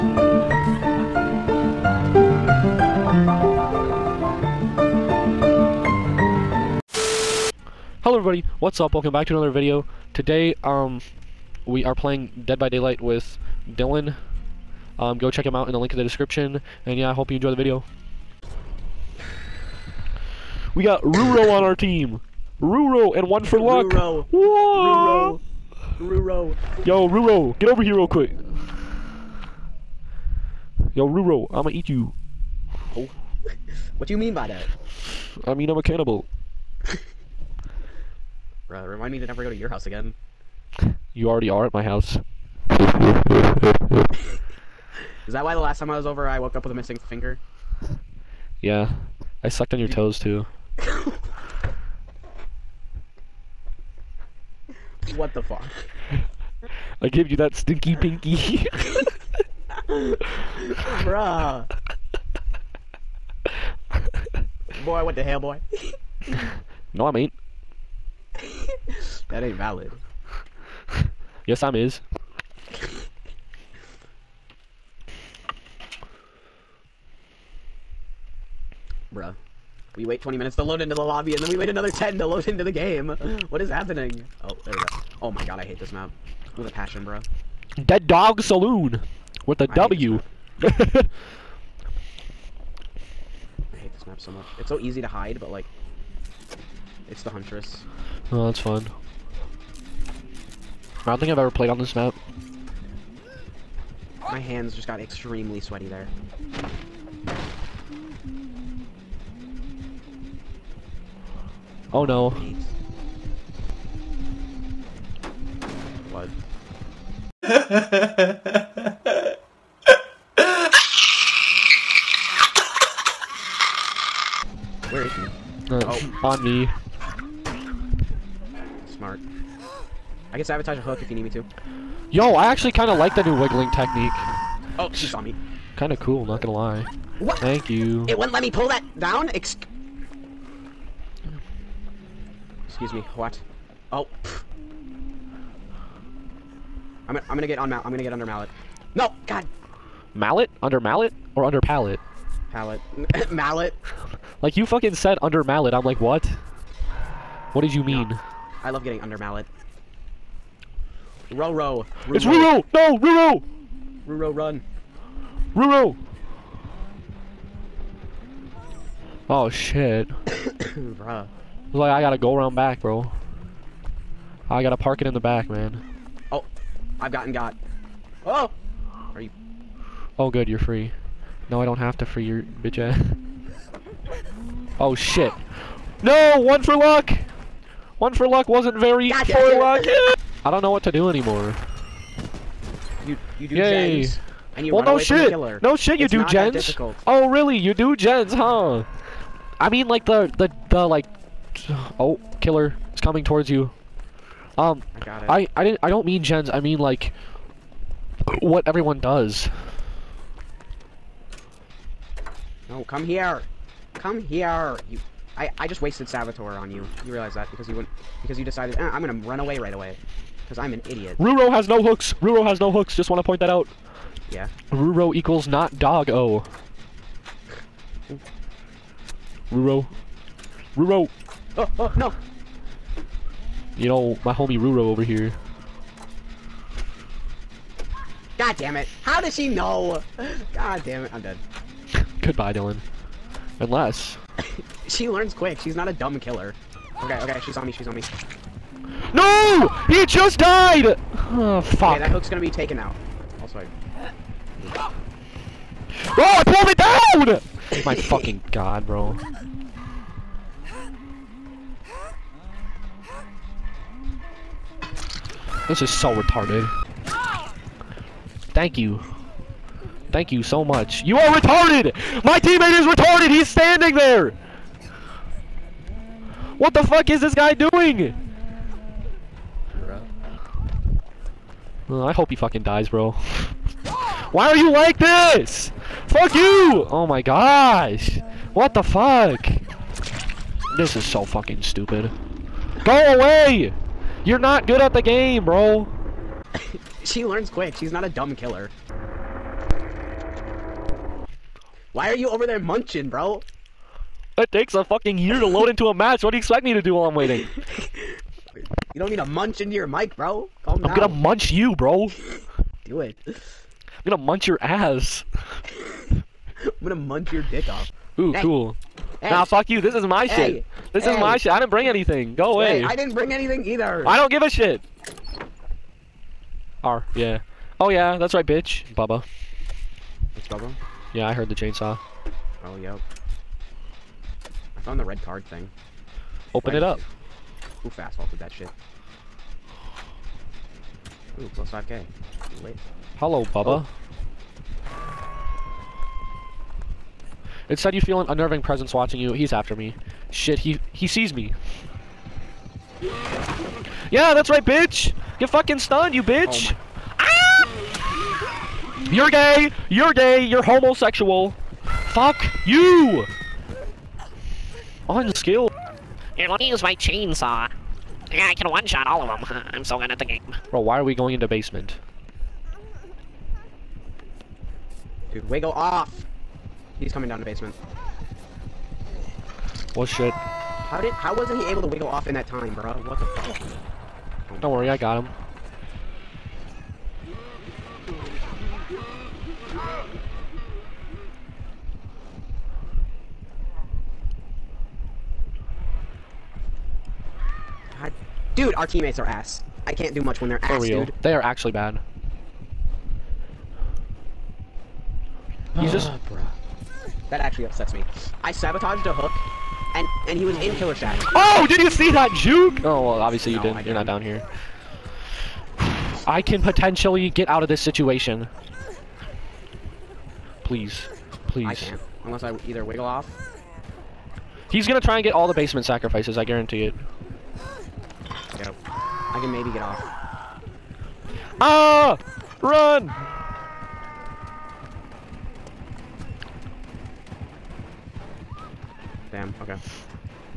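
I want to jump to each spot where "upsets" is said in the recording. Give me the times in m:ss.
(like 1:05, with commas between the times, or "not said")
6:47.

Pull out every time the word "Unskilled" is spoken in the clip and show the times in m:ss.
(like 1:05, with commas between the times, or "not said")
6:05.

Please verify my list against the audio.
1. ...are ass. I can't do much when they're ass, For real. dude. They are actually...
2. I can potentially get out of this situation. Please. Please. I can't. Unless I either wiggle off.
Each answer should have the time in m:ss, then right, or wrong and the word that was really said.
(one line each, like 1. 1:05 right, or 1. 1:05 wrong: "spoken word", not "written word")
1. 6:39 right
2. 6:56 right.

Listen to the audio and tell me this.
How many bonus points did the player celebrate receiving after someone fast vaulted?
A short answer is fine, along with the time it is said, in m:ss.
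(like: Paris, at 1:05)
5k, at 5:41.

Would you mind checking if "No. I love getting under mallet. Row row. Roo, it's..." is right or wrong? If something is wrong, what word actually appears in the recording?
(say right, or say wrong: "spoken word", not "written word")
right.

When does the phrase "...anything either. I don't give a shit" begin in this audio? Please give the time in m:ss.
5:23.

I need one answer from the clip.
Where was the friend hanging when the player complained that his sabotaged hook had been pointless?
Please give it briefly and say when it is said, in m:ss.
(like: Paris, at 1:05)
Killer Shack, at 6:50.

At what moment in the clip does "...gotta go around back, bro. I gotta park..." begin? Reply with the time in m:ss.
2:52.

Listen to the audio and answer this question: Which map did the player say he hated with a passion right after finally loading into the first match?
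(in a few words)
Dead Dog Saloon.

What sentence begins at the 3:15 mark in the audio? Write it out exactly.
No shit, you it's do gens.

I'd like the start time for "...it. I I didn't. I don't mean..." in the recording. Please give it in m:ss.
3:25.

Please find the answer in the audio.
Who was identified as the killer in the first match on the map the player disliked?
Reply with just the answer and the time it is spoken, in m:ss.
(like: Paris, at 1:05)
The Huntress, at 1:37.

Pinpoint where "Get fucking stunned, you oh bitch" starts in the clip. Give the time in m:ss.
5:55.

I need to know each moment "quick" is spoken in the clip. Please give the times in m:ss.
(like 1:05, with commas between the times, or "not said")
0:28, 4:05, 4:57.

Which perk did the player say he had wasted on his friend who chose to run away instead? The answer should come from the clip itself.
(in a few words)
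Saboteur.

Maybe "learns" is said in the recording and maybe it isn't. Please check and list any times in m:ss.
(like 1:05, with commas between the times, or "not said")
4:05, 4:57.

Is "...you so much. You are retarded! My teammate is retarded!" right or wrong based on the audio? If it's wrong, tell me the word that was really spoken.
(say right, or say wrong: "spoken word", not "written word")
right.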